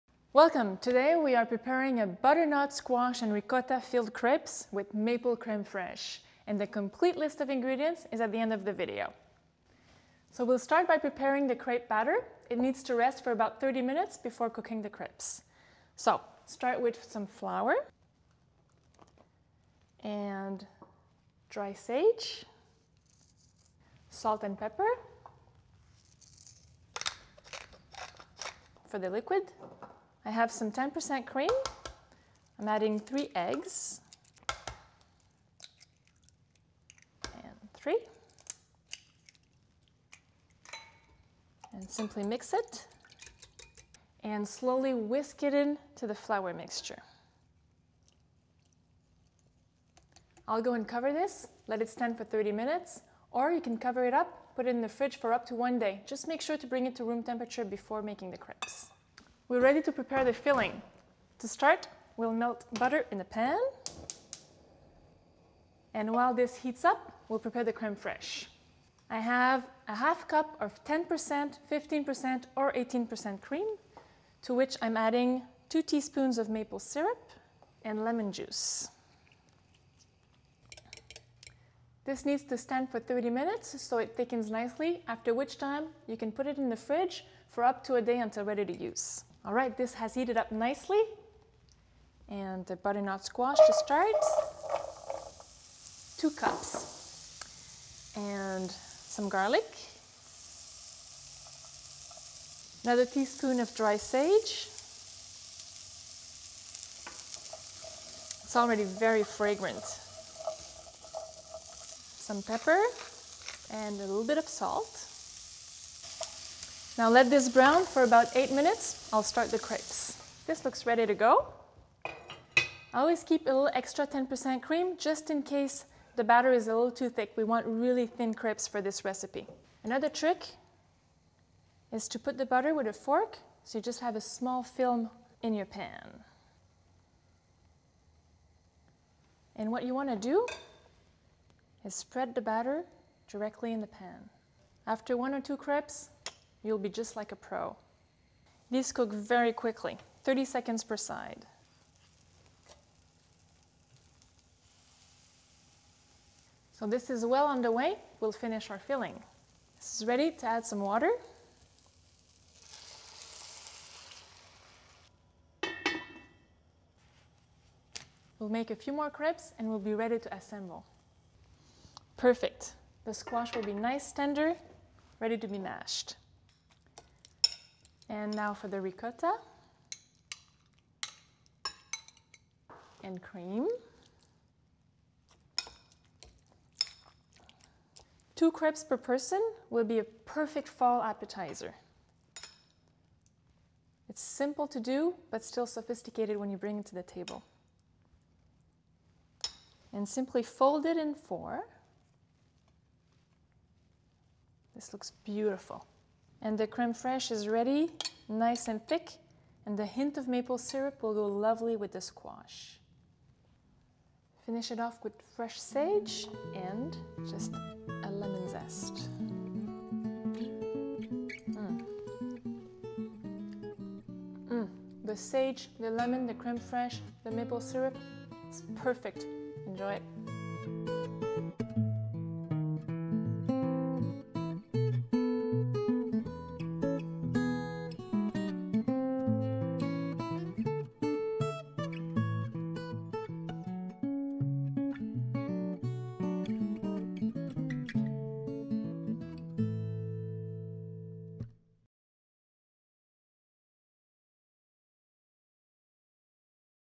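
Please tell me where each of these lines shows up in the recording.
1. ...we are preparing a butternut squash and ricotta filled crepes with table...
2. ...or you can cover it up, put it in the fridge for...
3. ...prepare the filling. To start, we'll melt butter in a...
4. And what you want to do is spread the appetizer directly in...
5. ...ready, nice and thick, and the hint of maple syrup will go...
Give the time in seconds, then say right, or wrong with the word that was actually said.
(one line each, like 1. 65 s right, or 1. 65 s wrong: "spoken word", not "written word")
1. 1 s wrong: "maple", not "table"
2. 53 s right
3. 59 s right
4. 139 s wrong: "batter", not "appetizer"
5. 207 s right.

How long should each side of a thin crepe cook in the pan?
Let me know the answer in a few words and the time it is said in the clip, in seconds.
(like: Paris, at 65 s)
30 seconds, at 150 s.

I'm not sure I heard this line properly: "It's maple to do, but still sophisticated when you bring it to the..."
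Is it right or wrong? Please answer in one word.
wrong.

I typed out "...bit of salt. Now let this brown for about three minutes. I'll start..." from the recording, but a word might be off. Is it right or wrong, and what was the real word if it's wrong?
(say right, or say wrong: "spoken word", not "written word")
wrong: "eight", not "three".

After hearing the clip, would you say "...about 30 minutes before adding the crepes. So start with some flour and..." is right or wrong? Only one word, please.
wrong.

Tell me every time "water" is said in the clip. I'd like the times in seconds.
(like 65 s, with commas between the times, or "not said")
160 s.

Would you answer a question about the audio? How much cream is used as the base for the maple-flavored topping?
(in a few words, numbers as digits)
half cup.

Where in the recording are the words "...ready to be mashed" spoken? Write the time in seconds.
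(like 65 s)
175 s.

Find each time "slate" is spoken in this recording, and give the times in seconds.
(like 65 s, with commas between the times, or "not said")
not said.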